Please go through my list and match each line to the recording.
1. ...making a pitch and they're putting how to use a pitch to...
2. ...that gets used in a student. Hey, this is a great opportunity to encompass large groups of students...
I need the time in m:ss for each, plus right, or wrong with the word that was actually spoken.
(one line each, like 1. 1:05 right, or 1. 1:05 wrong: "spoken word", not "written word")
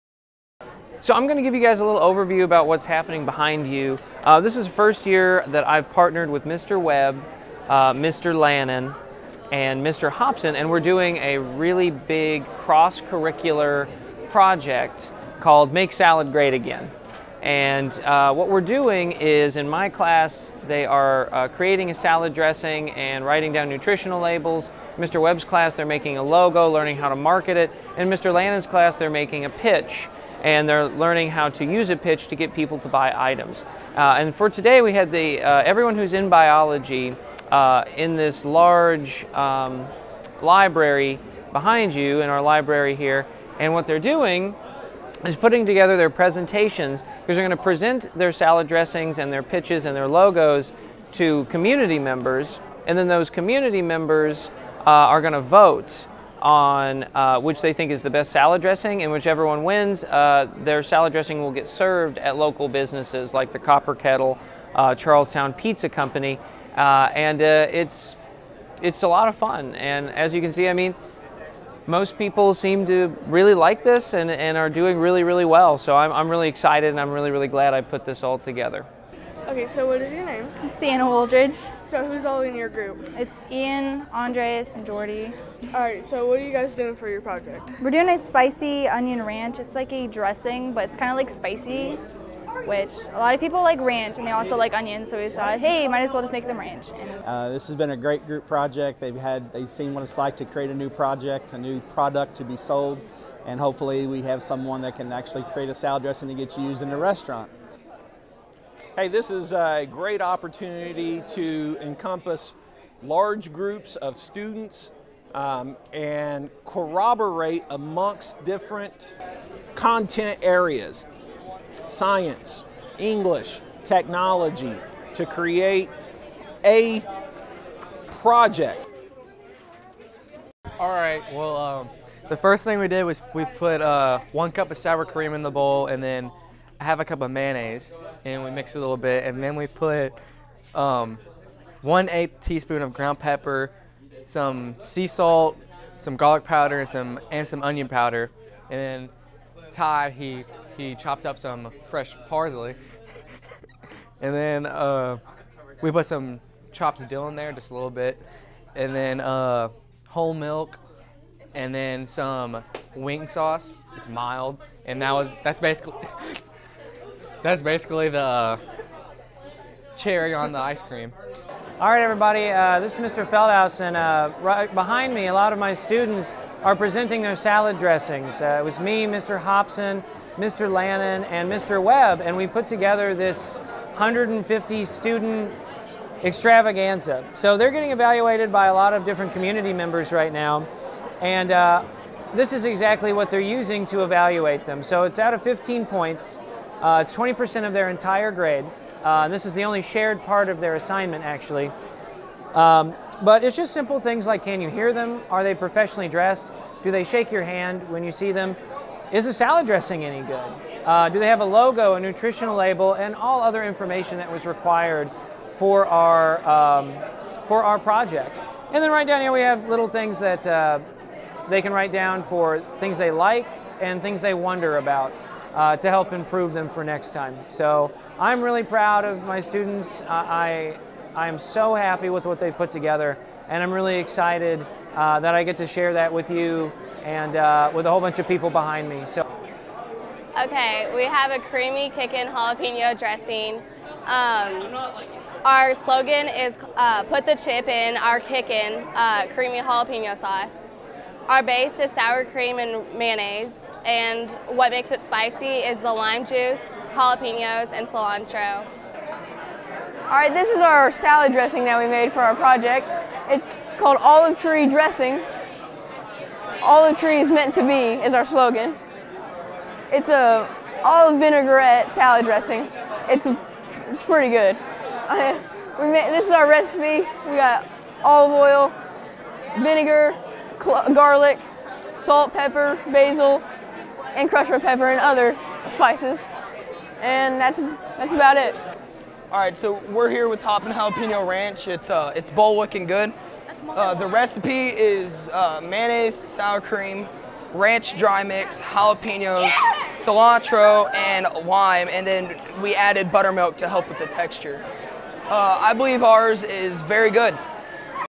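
1. 0:29 wrong: "learning", not "putting"
2. 1:46 wrong: "restaurant", not "student".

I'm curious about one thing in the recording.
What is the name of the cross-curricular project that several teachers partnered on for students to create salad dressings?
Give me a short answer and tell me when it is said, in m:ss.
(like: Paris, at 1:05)
Make Salad Great Again, at 0:15.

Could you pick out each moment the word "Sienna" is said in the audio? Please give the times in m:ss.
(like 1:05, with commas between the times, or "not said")
1:20.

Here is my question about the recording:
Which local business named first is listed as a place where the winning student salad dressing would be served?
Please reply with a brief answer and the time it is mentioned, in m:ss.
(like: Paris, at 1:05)
Copper Kettle, at 1:03.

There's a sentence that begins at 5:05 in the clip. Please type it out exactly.
Uh, I believe ours is very good.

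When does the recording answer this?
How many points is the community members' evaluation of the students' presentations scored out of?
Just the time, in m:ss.
3:15.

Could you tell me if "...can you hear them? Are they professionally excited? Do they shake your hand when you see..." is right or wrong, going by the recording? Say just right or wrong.
wrong.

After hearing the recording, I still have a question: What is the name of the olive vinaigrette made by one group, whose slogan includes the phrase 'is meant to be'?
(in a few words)
Olive Tree Dressing.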